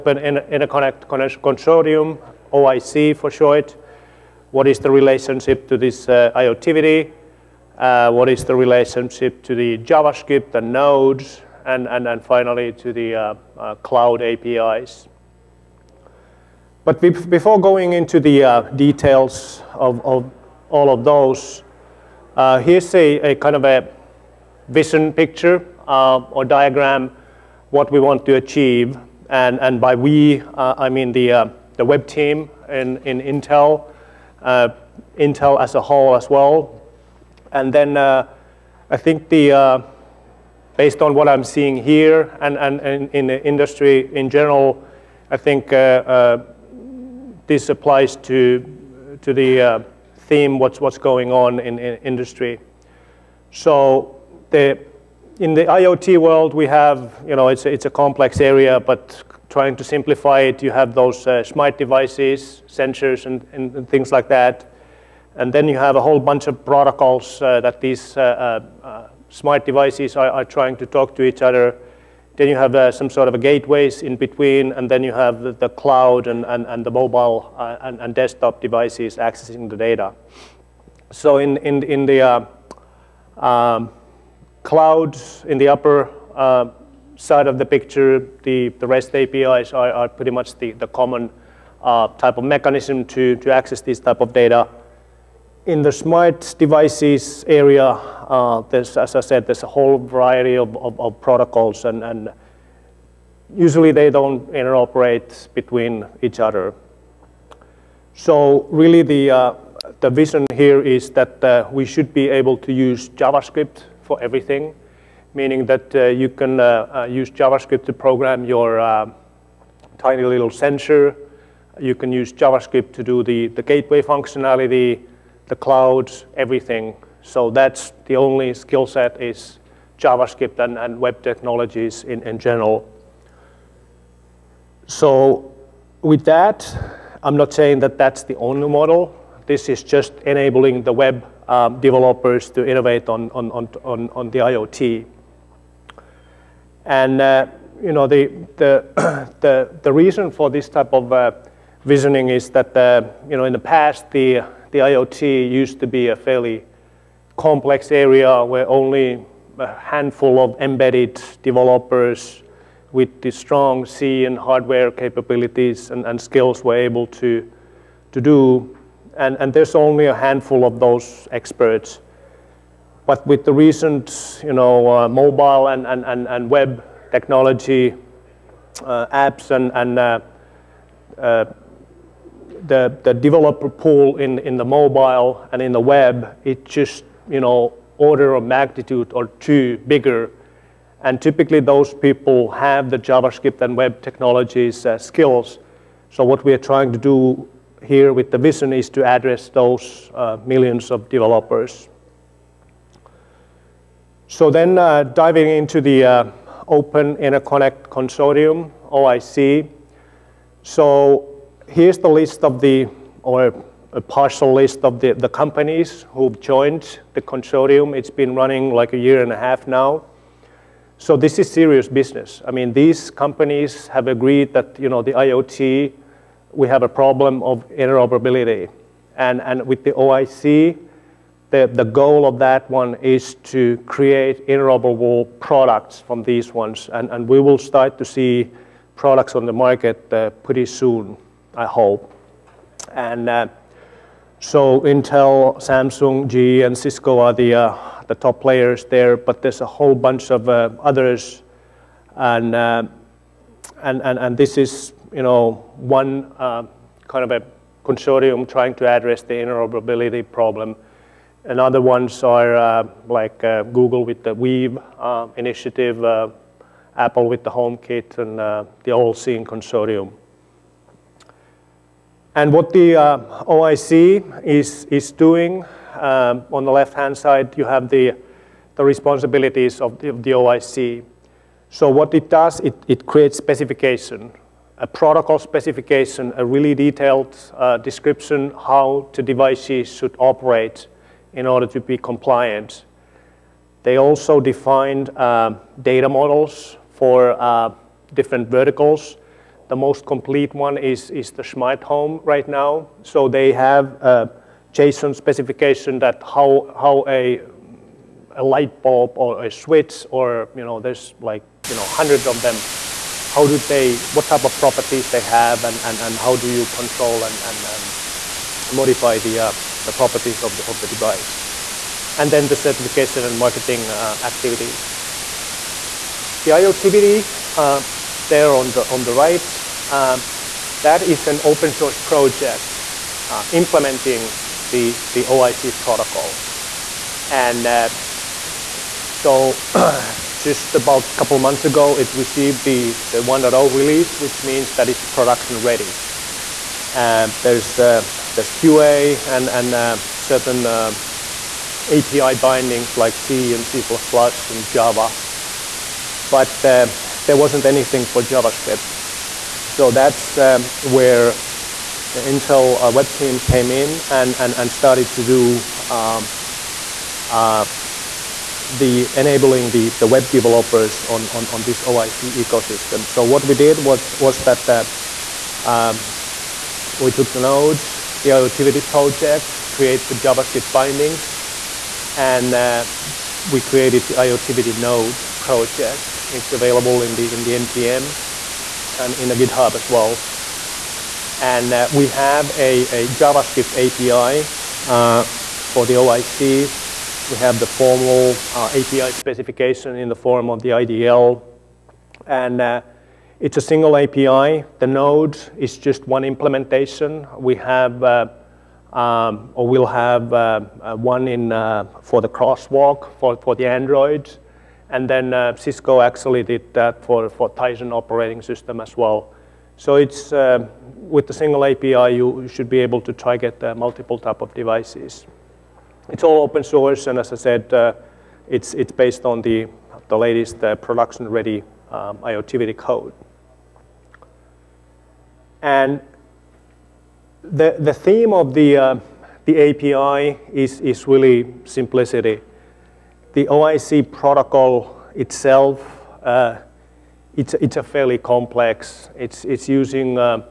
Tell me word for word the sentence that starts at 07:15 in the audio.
And the, the theme of the, uh, the API is, is really simplicity.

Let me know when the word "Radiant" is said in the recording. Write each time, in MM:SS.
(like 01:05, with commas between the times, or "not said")
not said.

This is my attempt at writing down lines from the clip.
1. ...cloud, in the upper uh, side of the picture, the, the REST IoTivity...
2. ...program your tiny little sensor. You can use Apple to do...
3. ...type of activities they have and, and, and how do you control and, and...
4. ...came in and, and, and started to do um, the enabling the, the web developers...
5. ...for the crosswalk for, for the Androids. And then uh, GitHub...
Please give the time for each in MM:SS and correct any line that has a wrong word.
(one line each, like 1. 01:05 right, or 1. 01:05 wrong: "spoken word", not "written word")
1. 01:24 wrong: "APIs", not "IoTivity"
2. 01:57 wrong: "JavaScript", not "Apple"
3. 05:14 wrong: "properties", not "activities"
4. 06:03 right
5. 06:52 wrong: "Cisco", not "GitHub".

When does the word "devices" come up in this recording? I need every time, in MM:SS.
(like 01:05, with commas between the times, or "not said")
01:01, 01:09, 01:18, 01:36, 04:49, 05:20, 07:04.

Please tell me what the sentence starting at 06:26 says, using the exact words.
It's available in the, in the NPM and in the GitHub as well.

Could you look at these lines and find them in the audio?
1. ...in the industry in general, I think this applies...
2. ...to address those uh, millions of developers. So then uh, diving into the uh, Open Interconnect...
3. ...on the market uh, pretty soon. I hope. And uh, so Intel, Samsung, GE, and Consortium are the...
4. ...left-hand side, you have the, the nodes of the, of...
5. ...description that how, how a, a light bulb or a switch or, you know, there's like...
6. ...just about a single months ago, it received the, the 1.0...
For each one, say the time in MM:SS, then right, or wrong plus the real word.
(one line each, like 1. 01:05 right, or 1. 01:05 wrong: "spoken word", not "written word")
1. 00:43 right
2. 03:18 right
3. 03:59 wrong: "Cisco", not "Consortium"
4. 04:36 wrong: "responsibilities", not "nodes"
5. 05:05 wrong: "specification", not "description"
6. 05:40 wrong: "couple", not "single".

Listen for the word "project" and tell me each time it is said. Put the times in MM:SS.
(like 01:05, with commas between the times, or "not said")
05:31, 06:18, 06:25.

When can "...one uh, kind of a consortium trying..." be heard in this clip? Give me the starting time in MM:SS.
04:15.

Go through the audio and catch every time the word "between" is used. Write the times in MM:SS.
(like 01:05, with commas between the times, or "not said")
01:14, 01:45.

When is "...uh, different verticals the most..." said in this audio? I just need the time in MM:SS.
04:57.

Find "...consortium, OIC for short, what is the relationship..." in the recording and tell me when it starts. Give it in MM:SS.
00:01.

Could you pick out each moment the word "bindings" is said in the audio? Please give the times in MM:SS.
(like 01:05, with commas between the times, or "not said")
05:52, 06:20.